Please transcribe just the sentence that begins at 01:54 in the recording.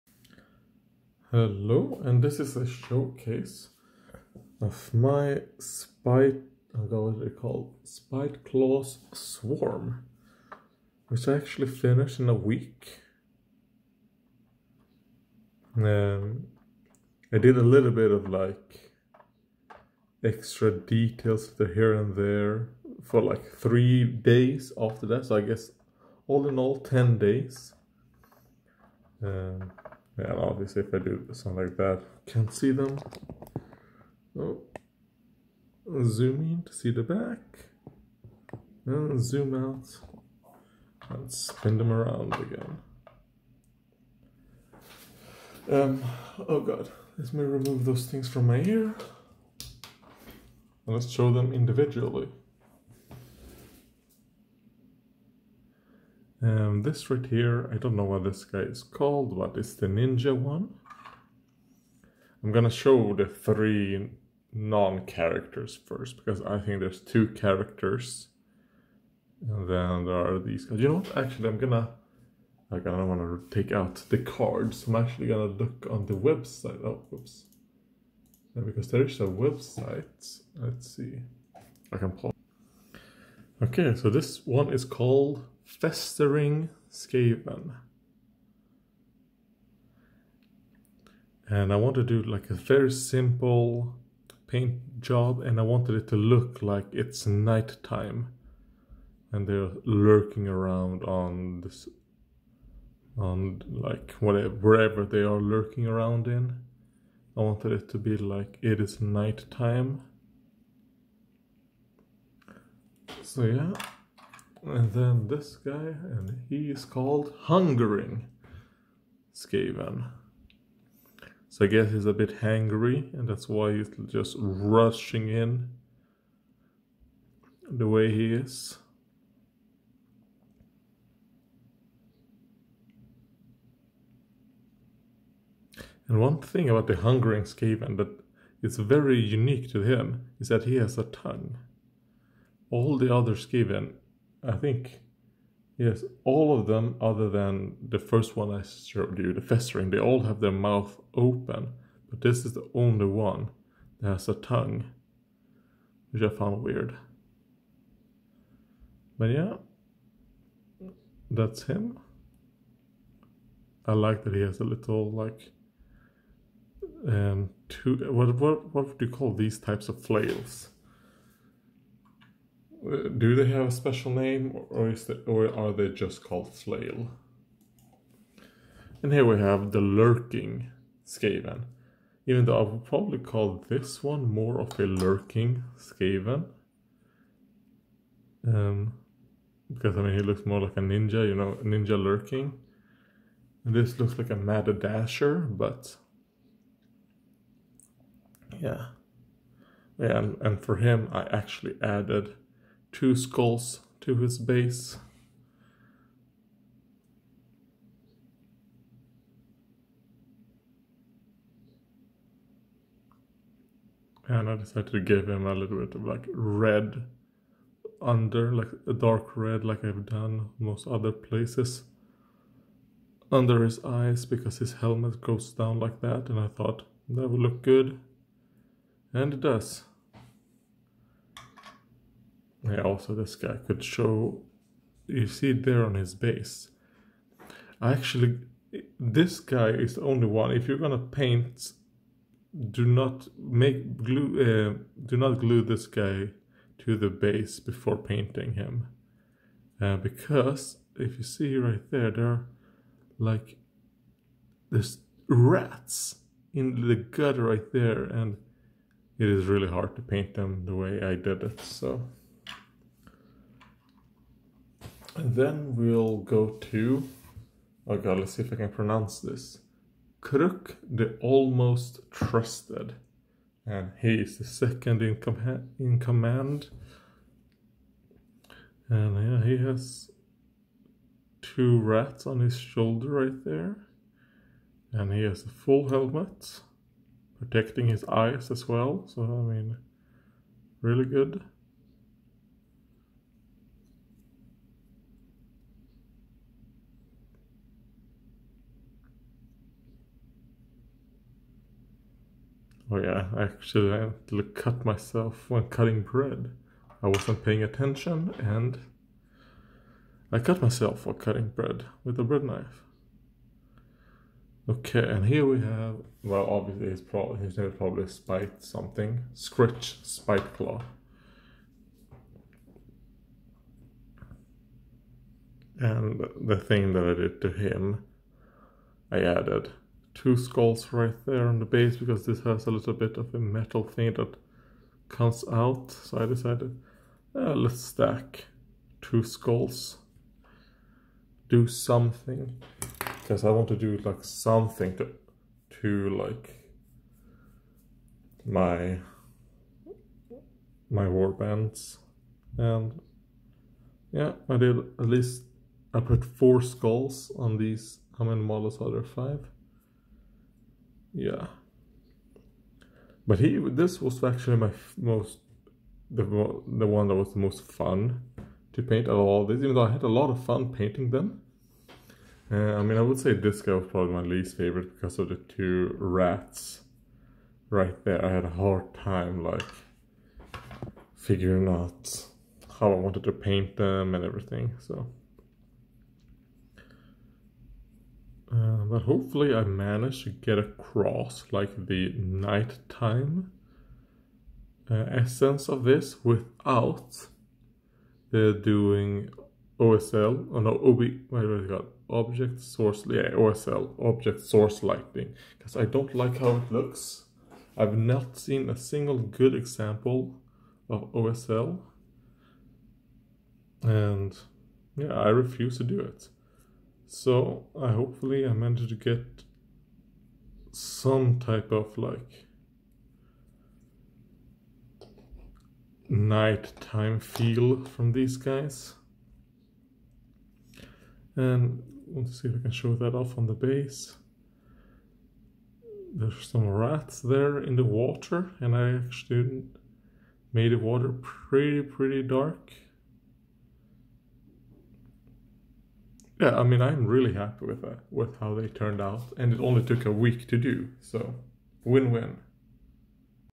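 And then this guy, and he is called Hungering Skaven.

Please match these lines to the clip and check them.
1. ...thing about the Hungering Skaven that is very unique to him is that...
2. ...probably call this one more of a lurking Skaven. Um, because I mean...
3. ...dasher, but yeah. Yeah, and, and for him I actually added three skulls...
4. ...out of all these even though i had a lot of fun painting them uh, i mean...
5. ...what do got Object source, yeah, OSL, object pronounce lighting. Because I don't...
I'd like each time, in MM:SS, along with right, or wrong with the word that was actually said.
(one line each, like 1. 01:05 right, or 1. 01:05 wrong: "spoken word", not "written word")
1. 02:16 right
2. 03:02 right
3. 03:14 wrong: "two", not "three"
4. 06:09 right
5. 06:41 wrong: "source", not "pronounce".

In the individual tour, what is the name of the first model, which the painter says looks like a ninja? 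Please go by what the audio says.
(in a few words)
Festering Skaven.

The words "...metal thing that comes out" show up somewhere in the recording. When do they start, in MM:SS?
05:33.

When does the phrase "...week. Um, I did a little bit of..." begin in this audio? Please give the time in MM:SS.
00:12.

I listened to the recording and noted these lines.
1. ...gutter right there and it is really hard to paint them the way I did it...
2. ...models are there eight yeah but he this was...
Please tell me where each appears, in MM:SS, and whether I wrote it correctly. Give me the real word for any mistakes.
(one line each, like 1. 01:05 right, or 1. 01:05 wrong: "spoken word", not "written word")
1. 04:16 right
2. 05:58 wrong: "five", not "eight".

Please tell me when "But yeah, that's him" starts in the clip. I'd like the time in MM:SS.
02:39.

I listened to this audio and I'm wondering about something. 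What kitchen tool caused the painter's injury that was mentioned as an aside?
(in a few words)
bread knife.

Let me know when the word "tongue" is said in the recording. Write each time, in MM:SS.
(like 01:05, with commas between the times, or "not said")
02:21, 02:34.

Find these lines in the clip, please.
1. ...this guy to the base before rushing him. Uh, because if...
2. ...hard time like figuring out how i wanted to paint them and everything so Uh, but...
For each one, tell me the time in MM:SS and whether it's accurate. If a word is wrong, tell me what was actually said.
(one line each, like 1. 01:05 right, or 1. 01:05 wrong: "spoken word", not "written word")
1. 04:05 wrong: "painting", not "rushing"
2. 06:18 right.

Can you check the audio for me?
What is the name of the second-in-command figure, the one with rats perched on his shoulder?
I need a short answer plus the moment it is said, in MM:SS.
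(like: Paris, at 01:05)
Krrk the Almost Trusted, at 04:30.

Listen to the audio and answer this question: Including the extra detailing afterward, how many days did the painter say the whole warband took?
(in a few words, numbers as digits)
10.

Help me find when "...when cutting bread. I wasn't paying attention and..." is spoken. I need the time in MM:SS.
05:05.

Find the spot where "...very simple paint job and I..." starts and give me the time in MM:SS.
01:32.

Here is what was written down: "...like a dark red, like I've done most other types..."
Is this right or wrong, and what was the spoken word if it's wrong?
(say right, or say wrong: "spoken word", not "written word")
wrong: "places", not "types".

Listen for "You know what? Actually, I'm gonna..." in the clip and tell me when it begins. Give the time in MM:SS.
01:10.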